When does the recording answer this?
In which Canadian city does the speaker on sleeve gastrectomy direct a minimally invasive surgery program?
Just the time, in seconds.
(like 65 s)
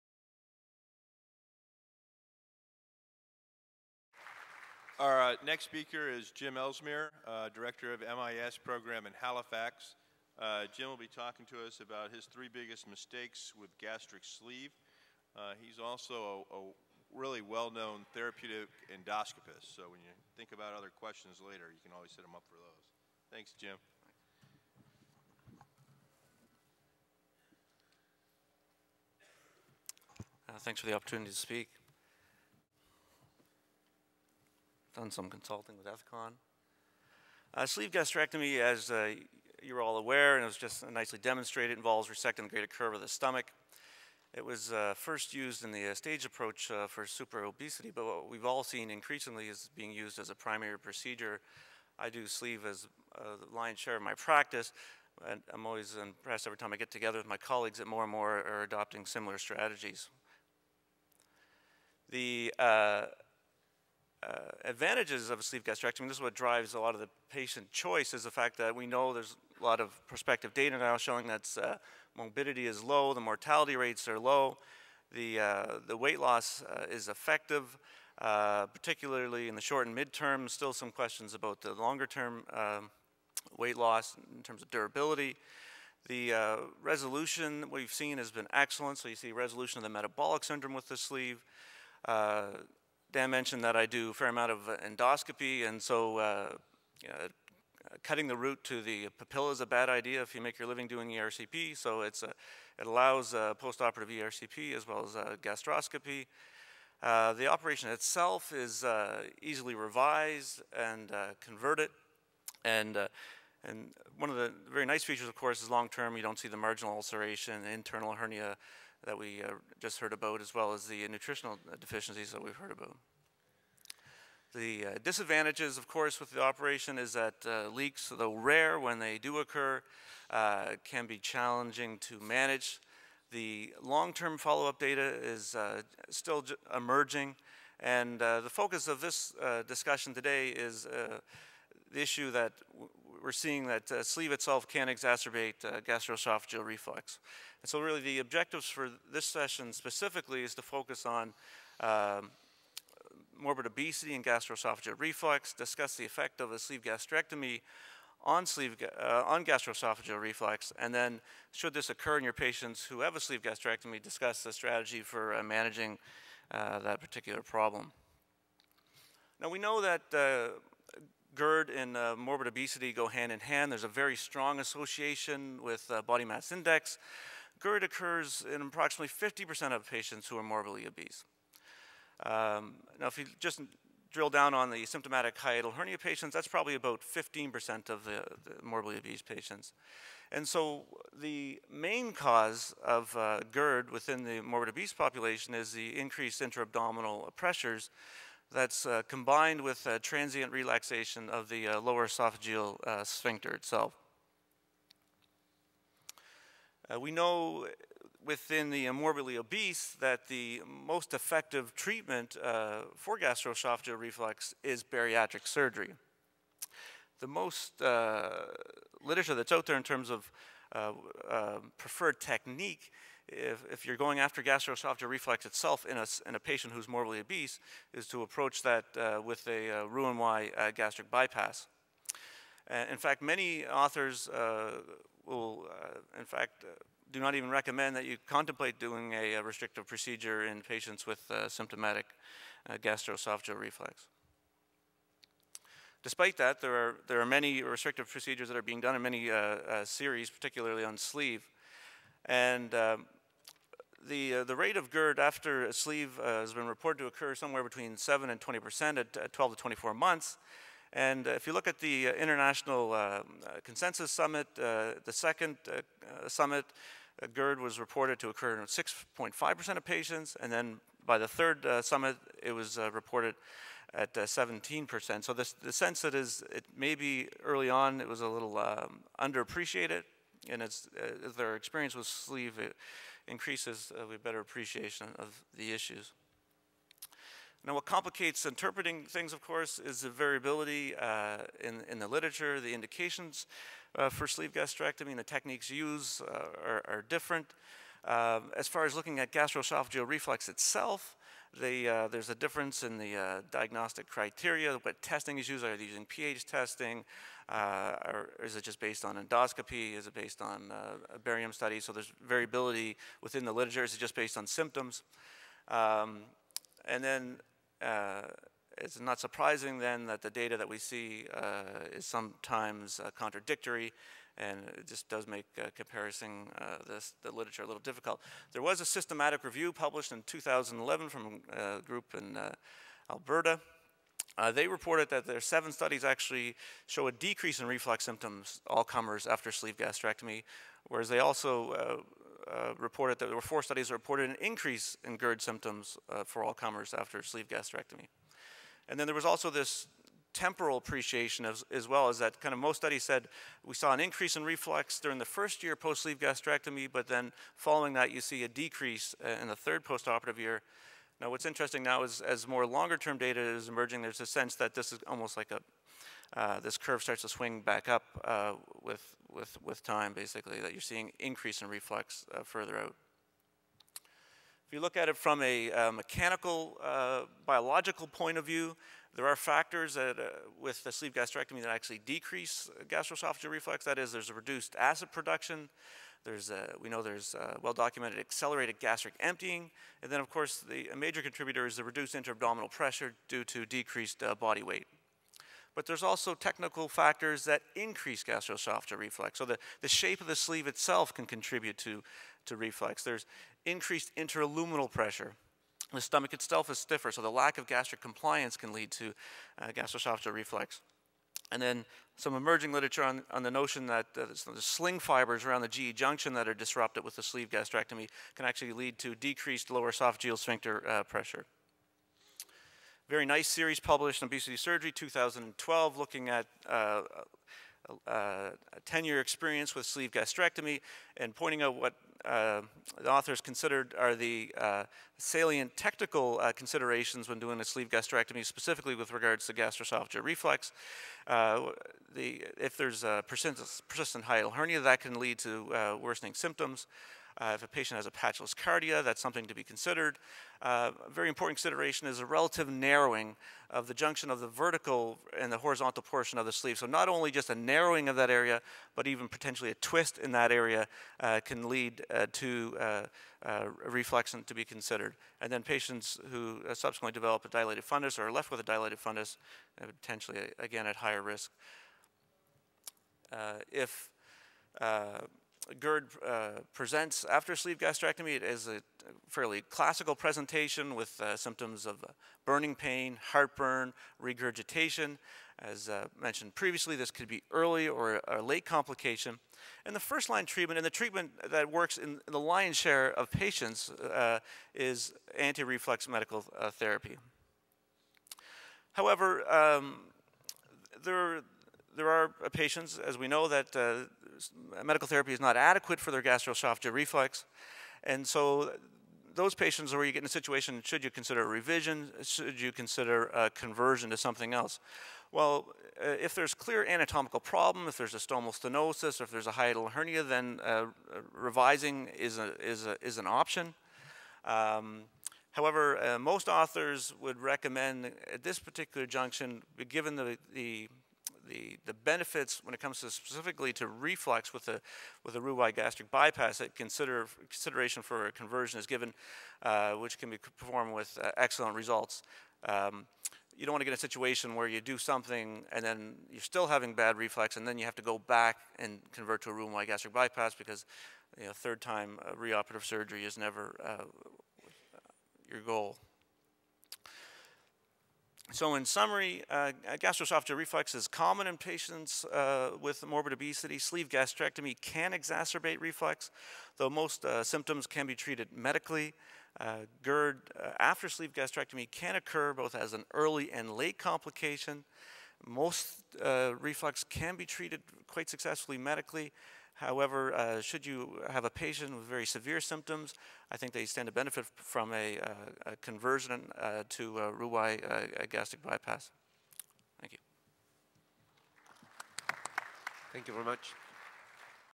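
9 s.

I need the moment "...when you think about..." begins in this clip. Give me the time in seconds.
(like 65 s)
19 s.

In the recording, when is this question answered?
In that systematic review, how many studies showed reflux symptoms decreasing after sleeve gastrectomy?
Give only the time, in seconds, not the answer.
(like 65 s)
335 s.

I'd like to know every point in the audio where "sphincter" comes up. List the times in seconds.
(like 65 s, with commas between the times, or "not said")
203 s, 420 s.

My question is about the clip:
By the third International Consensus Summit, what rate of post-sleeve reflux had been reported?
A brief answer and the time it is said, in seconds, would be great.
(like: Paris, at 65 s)
17%, at 274 s.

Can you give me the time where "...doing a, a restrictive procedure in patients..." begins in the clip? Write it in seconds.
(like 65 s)
238 s.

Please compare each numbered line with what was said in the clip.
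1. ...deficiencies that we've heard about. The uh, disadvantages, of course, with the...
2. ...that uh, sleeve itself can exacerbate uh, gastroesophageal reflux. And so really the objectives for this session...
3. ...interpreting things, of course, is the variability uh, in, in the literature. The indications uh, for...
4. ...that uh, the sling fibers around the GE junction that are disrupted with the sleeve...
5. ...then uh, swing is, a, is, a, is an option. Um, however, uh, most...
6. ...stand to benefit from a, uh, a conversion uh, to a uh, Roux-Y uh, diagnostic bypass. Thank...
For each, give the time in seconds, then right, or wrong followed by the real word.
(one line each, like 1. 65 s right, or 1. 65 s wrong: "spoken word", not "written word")
1. 121 s right
2. 143 s right
3. 288 s right
4. 413 s right
5. 520 s wrong: "revising", not "swing"
6. 583 s wrong: "gastric", not "diagnostic".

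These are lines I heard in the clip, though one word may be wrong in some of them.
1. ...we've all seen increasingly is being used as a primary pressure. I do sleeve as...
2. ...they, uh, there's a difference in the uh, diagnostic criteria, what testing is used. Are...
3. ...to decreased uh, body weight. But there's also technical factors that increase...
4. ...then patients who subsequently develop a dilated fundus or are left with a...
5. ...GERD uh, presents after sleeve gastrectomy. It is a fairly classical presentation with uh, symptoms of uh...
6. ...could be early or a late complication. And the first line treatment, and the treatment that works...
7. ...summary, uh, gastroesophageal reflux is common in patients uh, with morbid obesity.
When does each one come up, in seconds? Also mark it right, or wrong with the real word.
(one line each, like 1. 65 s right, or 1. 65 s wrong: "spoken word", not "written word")
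1. 48 s wrong: "procedure", not "pressure"
2. 301 s right
3. 393 s right
4. 465 s right
5. 475 s right
6. 487 s right
7. 558 s right.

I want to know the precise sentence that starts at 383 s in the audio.
That is, there's a reduced acid production.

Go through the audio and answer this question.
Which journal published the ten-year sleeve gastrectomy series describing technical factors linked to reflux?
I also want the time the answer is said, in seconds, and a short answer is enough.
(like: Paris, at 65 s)
Obesity Surgery, at 424 s.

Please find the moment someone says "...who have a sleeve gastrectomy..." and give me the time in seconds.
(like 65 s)
162 s.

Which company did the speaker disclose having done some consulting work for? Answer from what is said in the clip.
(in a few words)
Ethicon.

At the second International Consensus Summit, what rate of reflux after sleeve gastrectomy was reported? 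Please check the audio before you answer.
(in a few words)
6.5%.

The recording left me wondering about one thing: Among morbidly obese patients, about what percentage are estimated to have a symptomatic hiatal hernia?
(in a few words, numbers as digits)
15%.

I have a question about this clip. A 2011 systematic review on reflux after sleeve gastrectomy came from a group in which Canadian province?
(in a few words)
Alberta.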